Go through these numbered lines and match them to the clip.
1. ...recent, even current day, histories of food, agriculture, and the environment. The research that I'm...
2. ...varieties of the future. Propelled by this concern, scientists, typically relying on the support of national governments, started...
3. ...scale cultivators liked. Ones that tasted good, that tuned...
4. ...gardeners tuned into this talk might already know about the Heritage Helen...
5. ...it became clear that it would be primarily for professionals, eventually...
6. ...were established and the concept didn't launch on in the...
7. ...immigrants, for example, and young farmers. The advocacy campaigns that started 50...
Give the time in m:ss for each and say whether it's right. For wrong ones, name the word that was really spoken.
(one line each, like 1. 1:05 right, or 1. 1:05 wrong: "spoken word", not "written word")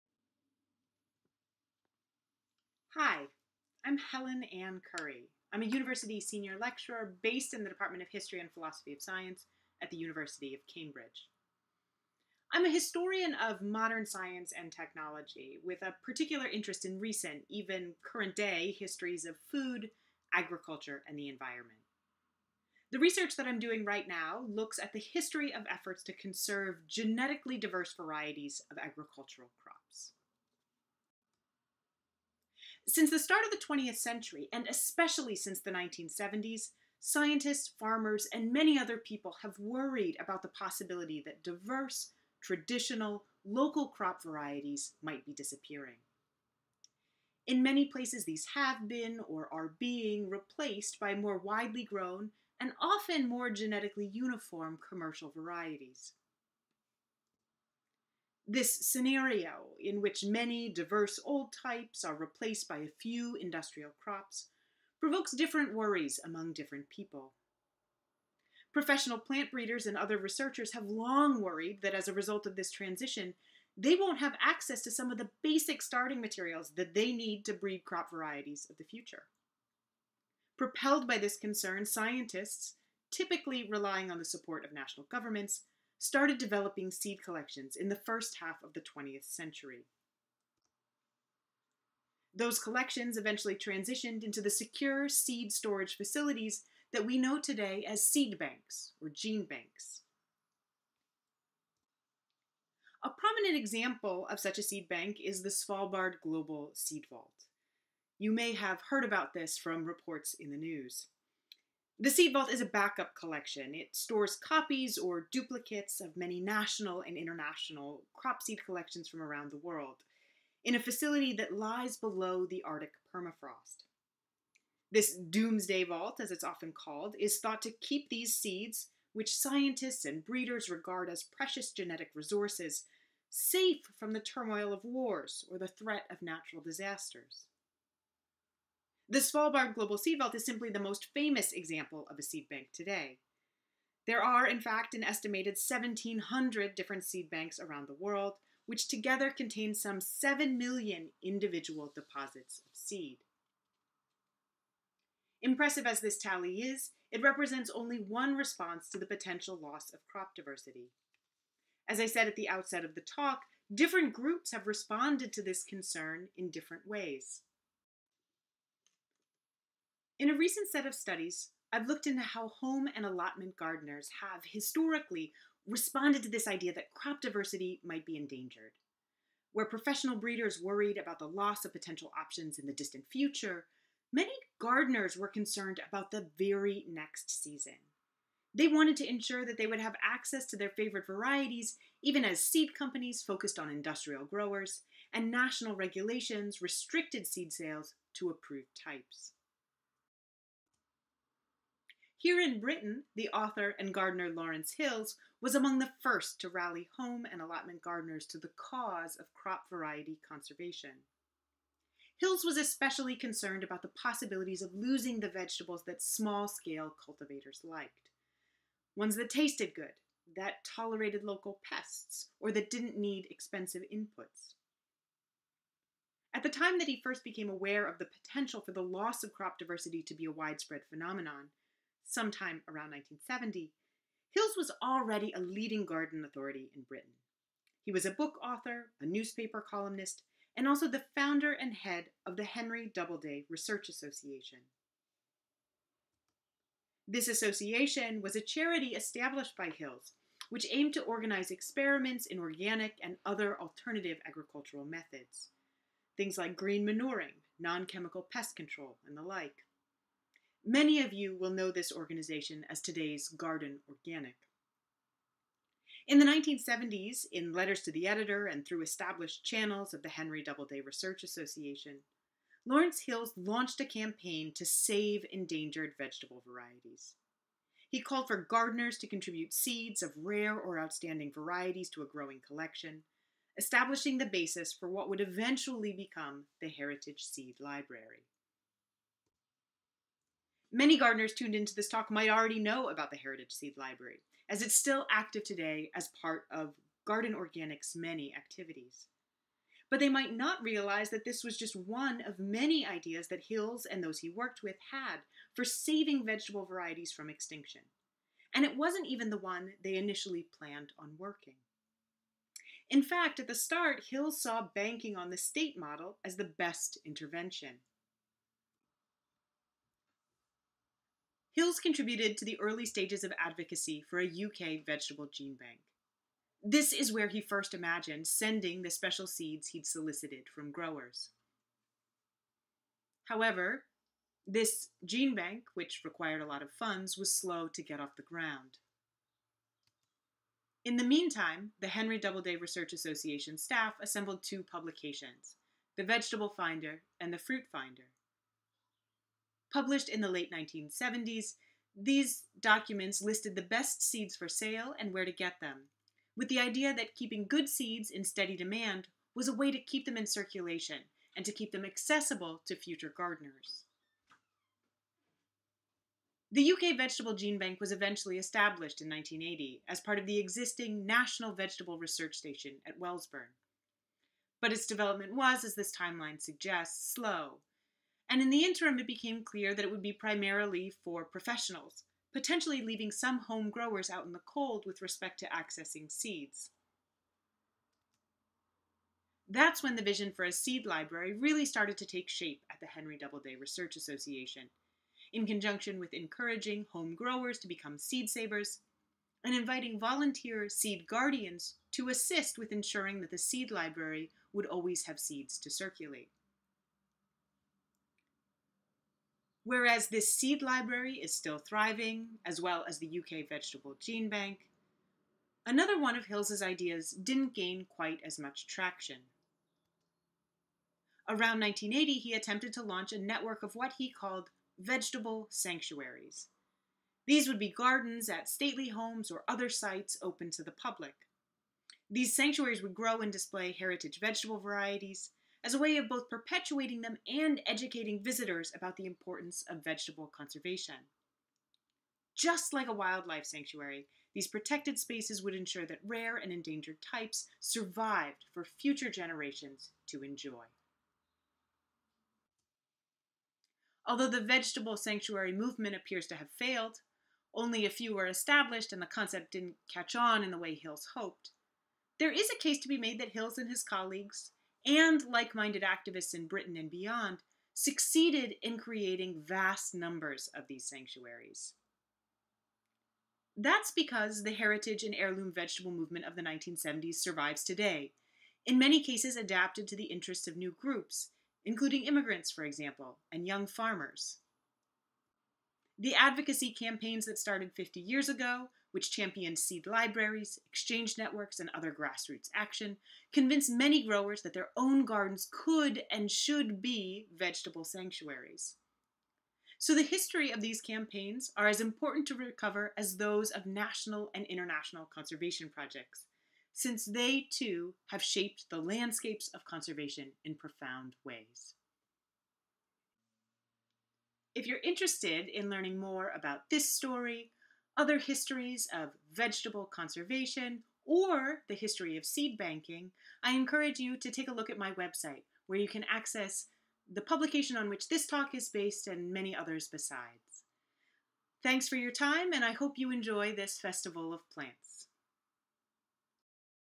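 1. 0:16 right
2. 1:18 right
3. 3:36 wrong: "tolerated", not "tuned"
4. 4:50 wrong: "Seed", not "Helen"
5. 6:18 wrong: "potentially", not "eventually"
6. 7:38 wrong: "catch", not "launch"
7. 8:02 right.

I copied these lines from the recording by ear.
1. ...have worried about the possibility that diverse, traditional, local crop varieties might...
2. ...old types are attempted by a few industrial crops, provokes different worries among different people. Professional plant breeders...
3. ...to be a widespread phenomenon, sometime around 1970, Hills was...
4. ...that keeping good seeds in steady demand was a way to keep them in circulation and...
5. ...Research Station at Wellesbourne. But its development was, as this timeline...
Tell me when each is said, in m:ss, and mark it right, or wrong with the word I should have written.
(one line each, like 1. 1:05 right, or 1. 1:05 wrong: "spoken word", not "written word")
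1. 0:39 right
2. 1:01 wrong: "replaced", not "attempted"
3. 3:50 right
4. 5:56 right
5. 6:11 right.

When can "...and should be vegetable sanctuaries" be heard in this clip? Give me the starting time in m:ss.
8:16.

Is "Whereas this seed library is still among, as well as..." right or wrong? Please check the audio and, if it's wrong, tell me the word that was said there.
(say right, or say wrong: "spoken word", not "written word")
wrong: "thriving", not "among".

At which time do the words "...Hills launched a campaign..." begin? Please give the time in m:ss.
4:33.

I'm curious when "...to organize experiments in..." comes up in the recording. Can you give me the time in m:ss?
4:10.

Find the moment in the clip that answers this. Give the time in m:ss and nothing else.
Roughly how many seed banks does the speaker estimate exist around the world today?
2:25.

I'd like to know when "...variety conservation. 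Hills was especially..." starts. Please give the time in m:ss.
3:29.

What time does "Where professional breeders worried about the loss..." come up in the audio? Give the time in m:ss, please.
2:59.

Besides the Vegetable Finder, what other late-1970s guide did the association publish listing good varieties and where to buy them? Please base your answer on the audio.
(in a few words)
Fruit Finder.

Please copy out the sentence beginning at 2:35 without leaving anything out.
Impressive as this tally is, it represents only one response to the potential loss of crop diversity.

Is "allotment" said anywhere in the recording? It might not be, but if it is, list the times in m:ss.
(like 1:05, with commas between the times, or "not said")
2:53, 3:27.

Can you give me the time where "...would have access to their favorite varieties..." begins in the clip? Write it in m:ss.
3:09.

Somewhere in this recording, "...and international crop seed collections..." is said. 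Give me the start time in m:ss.
1:57.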